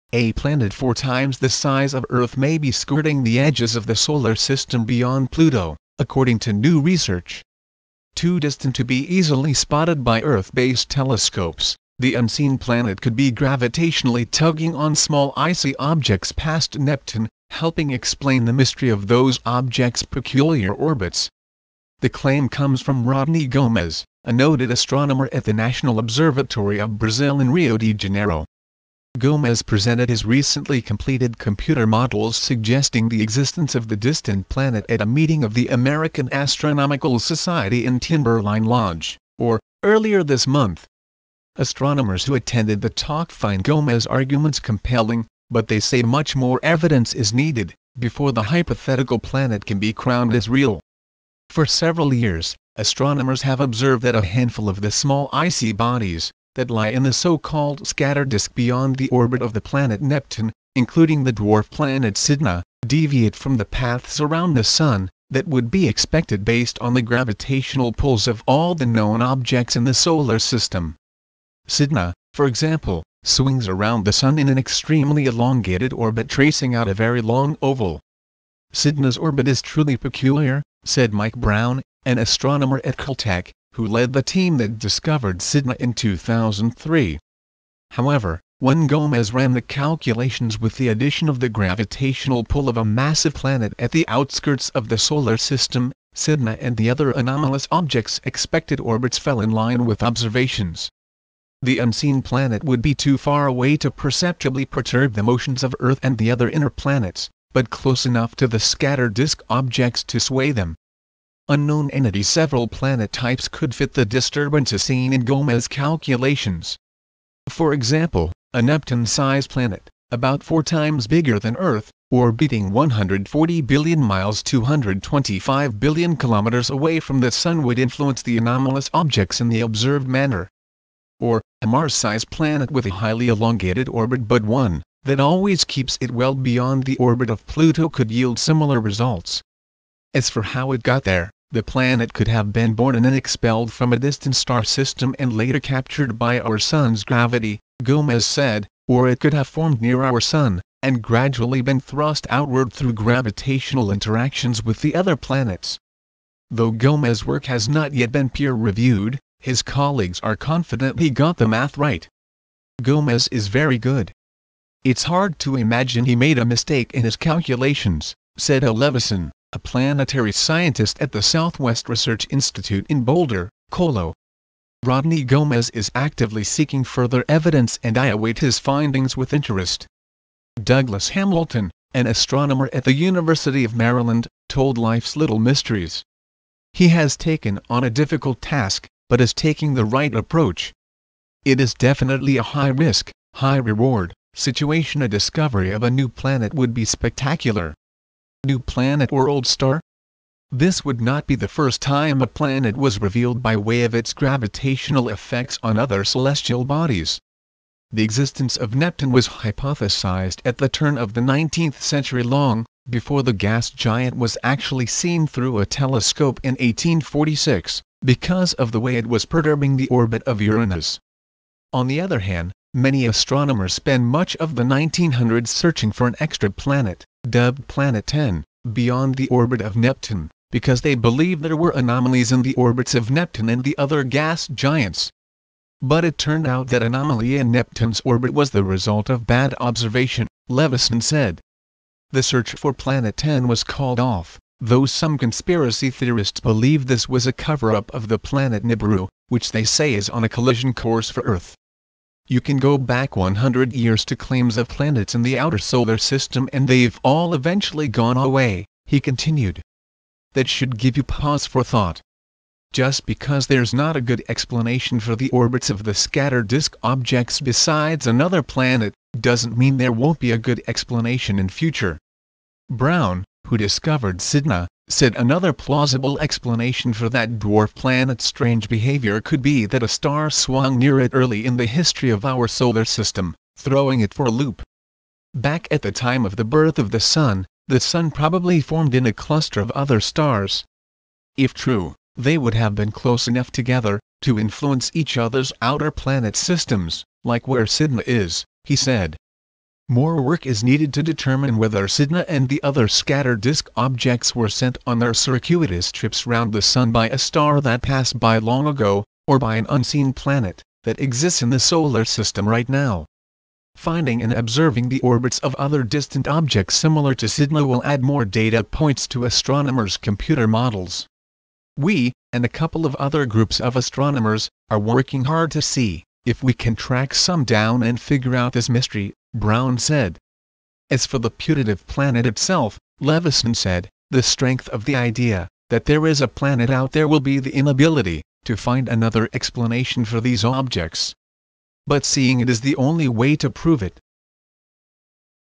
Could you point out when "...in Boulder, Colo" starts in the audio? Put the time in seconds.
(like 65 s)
172 s.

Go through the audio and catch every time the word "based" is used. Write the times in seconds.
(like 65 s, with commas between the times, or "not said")
10 s, 66 s.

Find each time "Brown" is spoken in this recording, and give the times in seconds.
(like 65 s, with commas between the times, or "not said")
81 s, 272 s, 329 s.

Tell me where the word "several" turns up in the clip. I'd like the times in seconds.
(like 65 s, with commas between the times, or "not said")
51 s, 112 s.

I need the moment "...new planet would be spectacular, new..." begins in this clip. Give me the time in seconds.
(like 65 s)
195 s.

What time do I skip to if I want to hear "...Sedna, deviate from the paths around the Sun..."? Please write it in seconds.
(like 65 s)
62 s.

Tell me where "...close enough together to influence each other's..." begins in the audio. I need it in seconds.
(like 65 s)
292 s.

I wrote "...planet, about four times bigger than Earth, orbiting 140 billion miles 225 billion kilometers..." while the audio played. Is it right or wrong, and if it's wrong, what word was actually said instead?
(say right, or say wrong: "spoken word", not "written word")
right.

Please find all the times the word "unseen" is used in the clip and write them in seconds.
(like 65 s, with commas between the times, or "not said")
12 s, 101 s, 309 s.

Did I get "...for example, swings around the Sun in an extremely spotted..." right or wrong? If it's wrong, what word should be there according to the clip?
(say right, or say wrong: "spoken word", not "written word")
wrong: "elongated", not "spotted".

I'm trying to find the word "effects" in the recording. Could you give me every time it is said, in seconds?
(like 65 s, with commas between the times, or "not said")
205 s.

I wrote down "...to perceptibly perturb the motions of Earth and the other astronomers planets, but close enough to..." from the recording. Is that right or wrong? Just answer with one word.
wrong.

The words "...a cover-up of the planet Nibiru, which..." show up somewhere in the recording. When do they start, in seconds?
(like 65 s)
247 s.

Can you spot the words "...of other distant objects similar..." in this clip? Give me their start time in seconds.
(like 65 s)
315 s.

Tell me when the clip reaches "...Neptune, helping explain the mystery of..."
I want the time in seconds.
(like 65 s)
16 s.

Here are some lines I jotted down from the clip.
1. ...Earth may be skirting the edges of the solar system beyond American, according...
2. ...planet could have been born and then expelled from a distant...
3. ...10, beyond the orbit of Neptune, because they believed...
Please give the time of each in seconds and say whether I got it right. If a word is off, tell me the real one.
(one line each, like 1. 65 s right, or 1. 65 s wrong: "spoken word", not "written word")
1. 2 s wrong: "Pluto", not "American"
2. 141 s right
3. 228 s right.